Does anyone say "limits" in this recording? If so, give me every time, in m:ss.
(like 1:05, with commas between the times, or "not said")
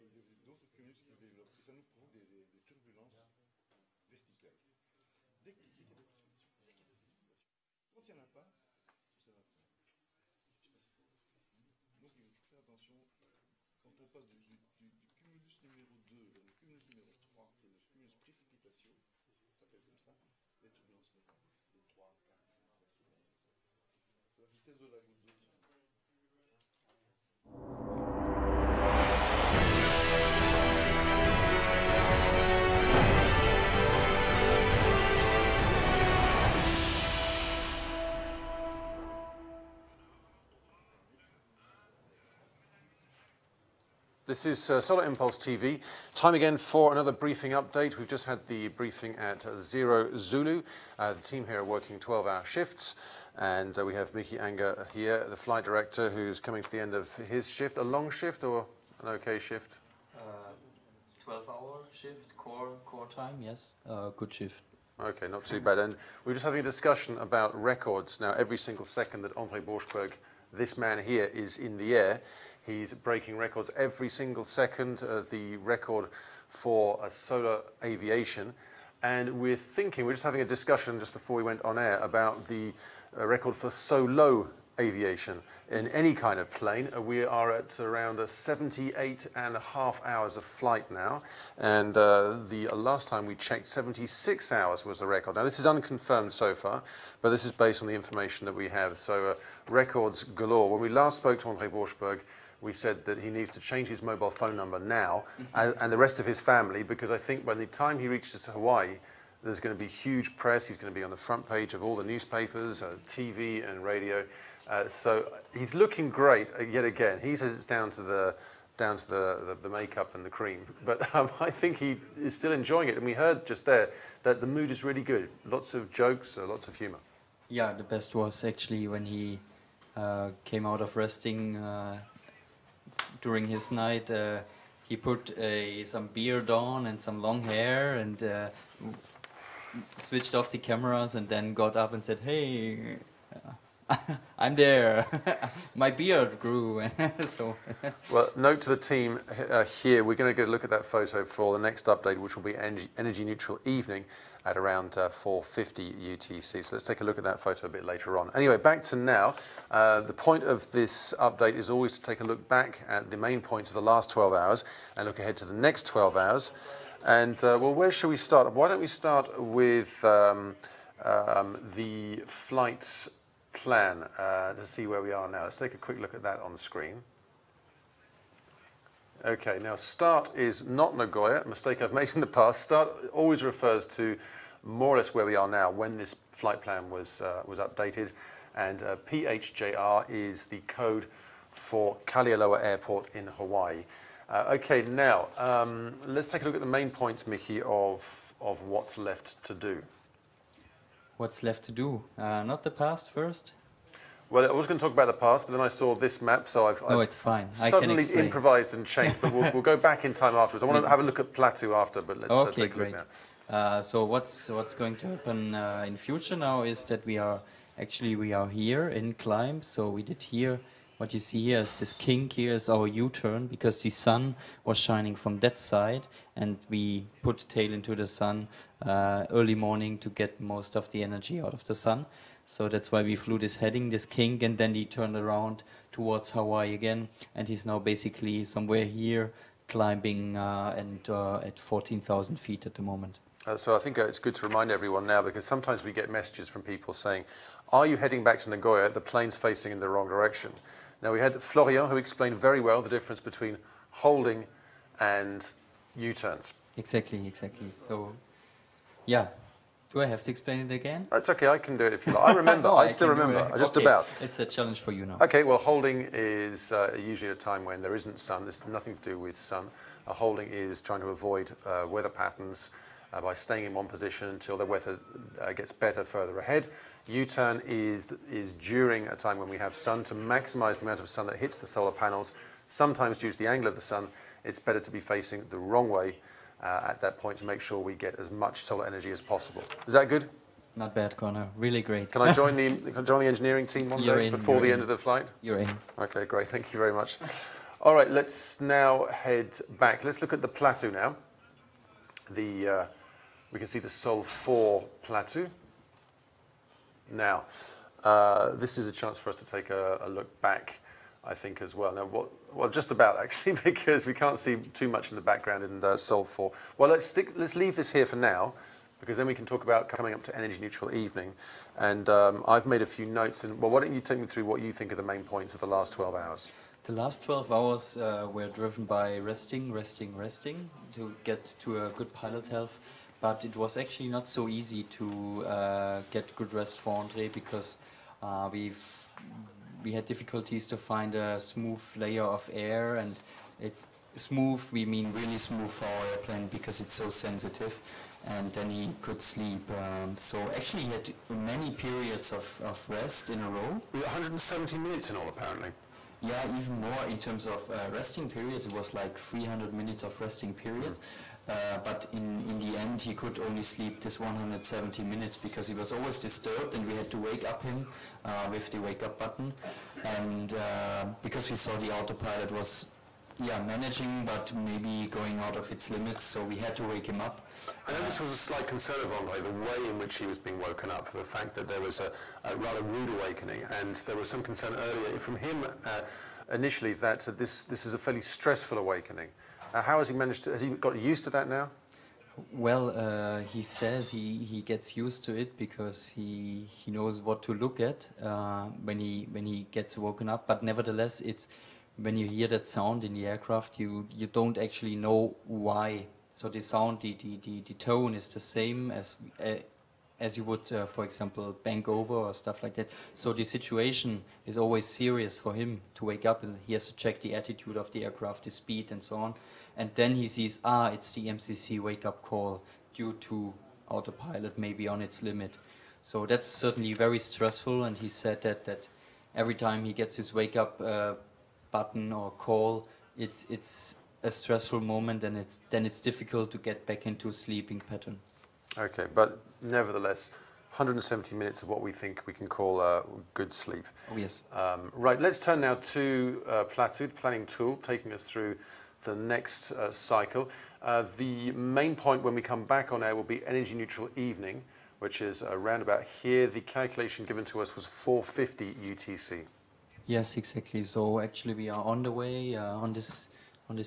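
6:15, 7:05.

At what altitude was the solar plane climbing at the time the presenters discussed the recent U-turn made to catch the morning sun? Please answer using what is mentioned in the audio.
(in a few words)
14,000 feet.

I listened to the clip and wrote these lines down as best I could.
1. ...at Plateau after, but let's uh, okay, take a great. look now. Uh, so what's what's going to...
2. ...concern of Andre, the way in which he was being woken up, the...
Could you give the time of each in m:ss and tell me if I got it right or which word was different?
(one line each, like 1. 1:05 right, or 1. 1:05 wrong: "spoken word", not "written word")
1. 3:31 right
2. 6:18 right.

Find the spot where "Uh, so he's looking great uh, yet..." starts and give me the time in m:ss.
1:54.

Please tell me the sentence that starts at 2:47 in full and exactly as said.
And, uh, well, where should we start?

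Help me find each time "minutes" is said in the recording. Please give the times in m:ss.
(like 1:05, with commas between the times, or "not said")
5:54, 5:59, 6:05, 7:21.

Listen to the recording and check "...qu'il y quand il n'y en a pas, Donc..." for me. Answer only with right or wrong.
right.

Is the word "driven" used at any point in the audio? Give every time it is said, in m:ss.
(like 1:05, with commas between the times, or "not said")
5:28.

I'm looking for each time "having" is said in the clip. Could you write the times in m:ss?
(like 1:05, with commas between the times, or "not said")
1:06, 1:20.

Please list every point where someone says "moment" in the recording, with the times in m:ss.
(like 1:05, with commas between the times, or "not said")
4:02, 7:14.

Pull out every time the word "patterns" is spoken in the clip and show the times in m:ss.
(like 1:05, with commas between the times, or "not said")
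4:32, 7:17.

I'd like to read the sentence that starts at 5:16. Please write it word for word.
Well, let's, stick, let's leave this here for now, because then we can talk about coming up to Energy Neutral Evening.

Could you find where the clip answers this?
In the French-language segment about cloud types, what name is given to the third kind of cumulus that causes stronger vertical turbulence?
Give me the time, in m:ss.
0:17.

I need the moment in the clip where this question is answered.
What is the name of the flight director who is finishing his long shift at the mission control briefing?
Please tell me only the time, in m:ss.
0:54.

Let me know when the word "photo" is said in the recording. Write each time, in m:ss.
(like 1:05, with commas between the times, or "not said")
2:30, 2:37.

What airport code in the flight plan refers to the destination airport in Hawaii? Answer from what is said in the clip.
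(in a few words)
PHJR.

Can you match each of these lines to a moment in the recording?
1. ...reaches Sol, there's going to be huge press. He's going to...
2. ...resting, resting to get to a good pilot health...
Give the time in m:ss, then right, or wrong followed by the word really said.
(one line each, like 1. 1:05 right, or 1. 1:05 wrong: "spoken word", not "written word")
1. 1:48 wrong: "Hawaii", not "Sol"
2. 5:29 right.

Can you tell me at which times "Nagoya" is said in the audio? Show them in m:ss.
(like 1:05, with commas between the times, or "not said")
3:00, 4:08.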